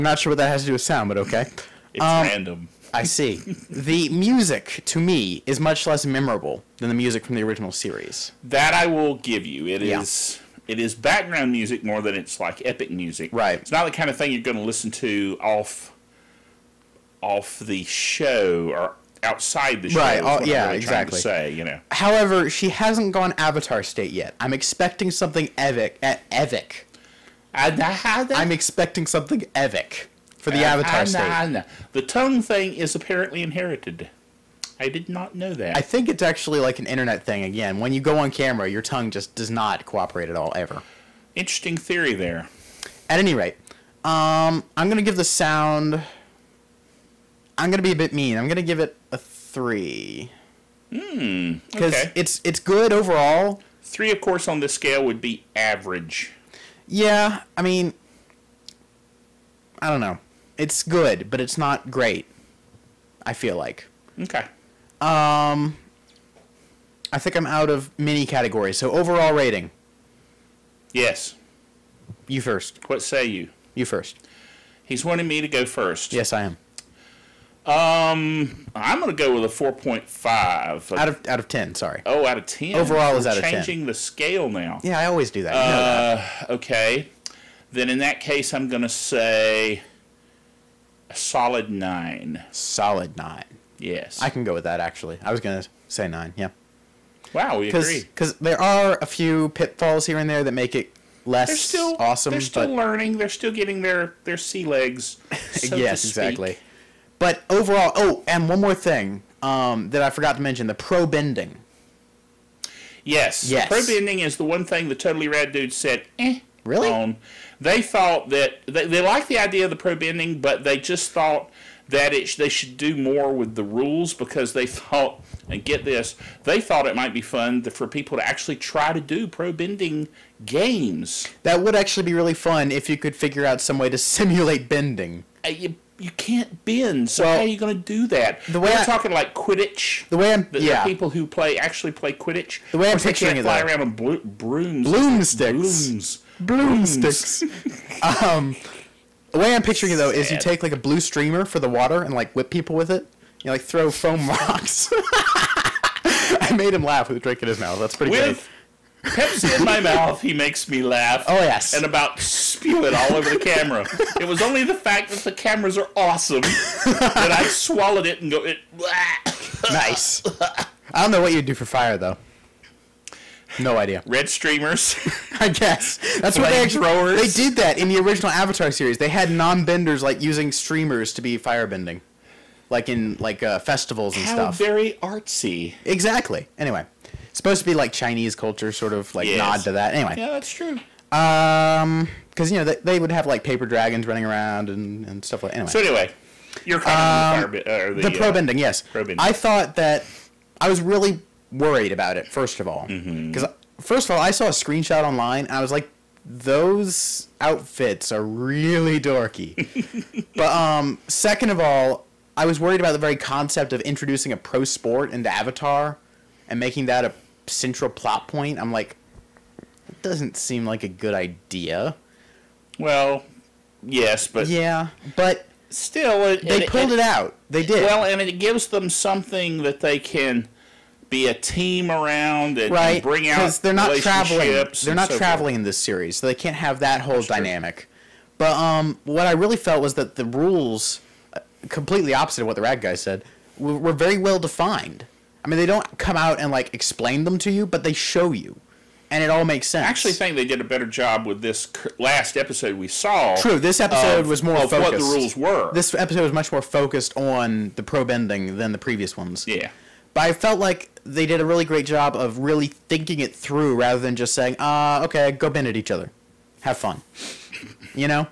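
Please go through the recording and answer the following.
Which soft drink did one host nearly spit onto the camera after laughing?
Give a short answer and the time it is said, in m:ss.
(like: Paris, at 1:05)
Pepsi, at 2:39.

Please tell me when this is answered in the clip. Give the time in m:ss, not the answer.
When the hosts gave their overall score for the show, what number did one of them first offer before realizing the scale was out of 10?
1:19.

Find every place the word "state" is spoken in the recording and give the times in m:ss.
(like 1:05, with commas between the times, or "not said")
0:23, 0:31.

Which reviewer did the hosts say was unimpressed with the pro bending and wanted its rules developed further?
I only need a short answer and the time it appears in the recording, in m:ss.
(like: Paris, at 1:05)
Totally Rad dude, at 1:54.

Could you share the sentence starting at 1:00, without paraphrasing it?
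It's good, but it's not great.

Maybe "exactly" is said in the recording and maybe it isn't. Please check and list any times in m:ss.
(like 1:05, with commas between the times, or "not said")
0:20, 1:46, 3:05.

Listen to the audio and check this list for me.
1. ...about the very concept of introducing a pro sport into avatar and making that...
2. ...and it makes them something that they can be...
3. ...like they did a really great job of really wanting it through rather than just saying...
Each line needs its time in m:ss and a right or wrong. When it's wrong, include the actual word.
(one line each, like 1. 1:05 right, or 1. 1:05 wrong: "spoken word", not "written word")
1. 3:32 right
2. 3:48 wrong: "gives", not "makes"
3. 4:20 wrong: "thinking", not "wanting".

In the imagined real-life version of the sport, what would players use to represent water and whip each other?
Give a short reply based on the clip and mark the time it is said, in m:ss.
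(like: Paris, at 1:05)
Blue streamer, at 2:30.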